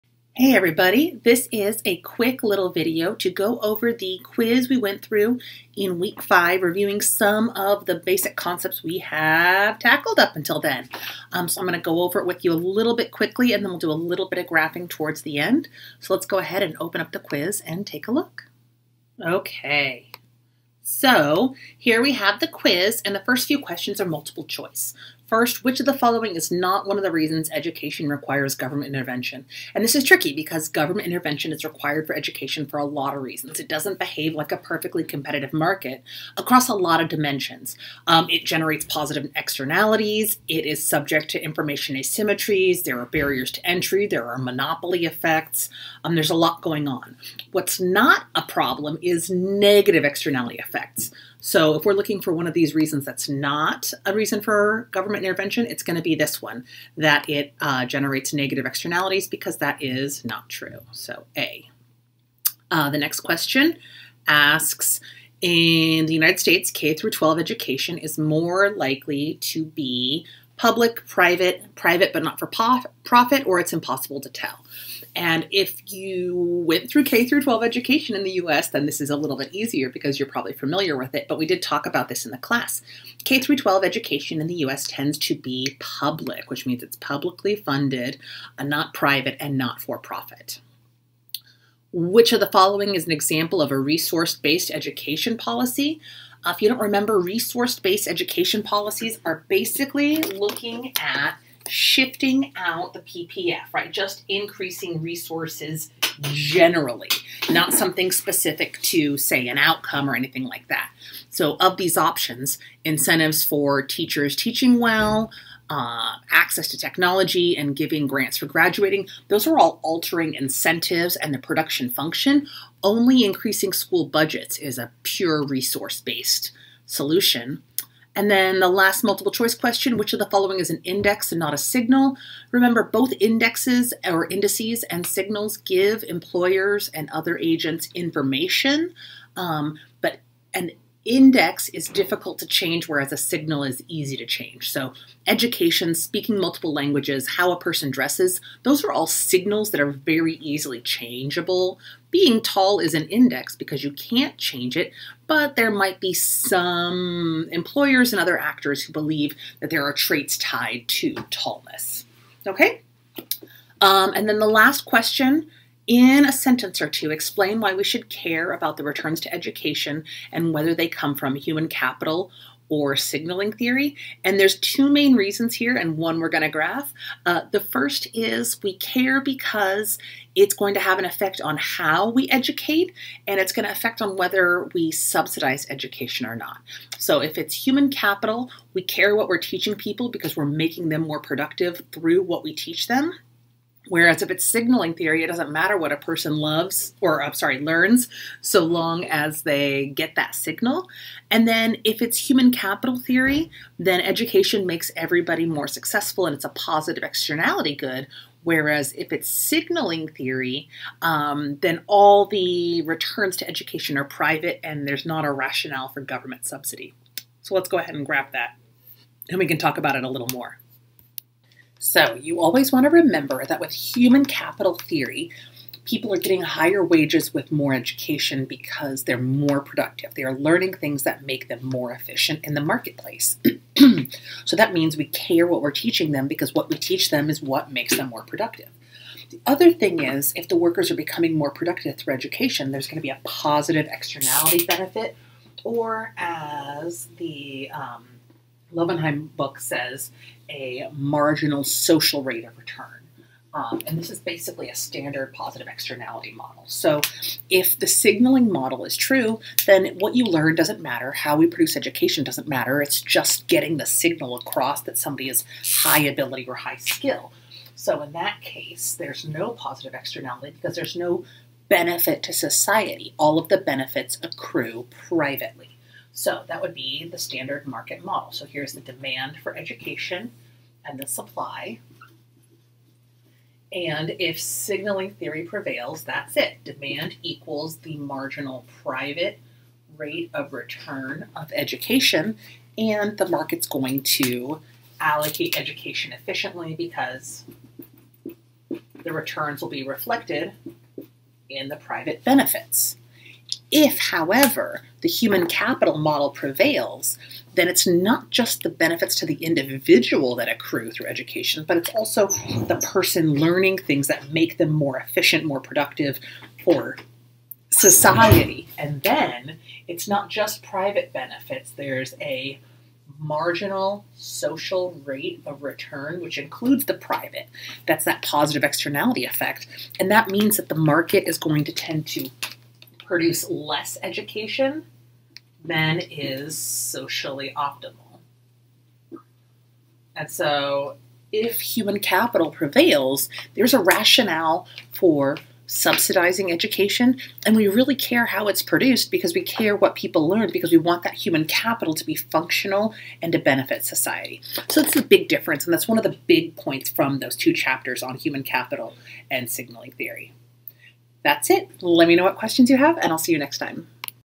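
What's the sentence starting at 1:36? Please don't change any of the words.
Uh, if you don't remember, resource based education policies are basically looking at shifting out the PPF, right?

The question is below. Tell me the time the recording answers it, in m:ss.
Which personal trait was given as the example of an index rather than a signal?
2:32.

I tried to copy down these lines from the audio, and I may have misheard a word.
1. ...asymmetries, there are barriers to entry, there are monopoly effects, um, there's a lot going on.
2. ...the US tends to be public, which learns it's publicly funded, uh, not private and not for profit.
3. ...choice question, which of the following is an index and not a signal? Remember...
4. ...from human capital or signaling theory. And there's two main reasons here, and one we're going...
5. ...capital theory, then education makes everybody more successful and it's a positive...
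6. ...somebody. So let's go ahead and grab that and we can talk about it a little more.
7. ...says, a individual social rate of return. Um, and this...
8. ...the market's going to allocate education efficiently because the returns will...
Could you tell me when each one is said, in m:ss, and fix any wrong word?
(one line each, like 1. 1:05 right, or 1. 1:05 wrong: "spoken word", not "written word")
1. 0:41 right
2. 1:24 wrong: "means", not "learns"
3. 2:09 right
4. 2:51 right
5. 3:22 right
6. 3:36 wrong: "subsidy", not "somebody"
7. 4:09 wrong: "marginal", not "individual"
8. 4:53 right.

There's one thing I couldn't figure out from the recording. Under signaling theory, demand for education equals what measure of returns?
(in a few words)
Marginal private rate of return.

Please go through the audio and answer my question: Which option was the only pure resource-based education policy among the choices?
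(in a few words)
Increasing school budgets.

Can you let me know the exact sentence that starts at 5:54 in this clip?
So that's a big difference, and that's one of the big points from those two chapters on human capital and signaling theory.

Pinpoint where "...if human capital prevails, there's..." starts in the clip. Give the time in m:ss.
5:41.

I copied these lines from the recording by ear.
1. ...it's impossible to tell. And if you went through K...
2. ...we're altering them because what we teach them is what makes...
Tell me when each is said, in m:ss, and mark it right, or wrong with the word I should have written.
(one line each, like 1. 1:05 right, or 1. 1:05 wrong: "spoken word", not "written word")
1. 1:13 right
2. 3:55 wrong: "teaching", not "altering".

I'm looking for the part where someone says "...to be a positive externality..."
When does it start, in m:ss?
4:02.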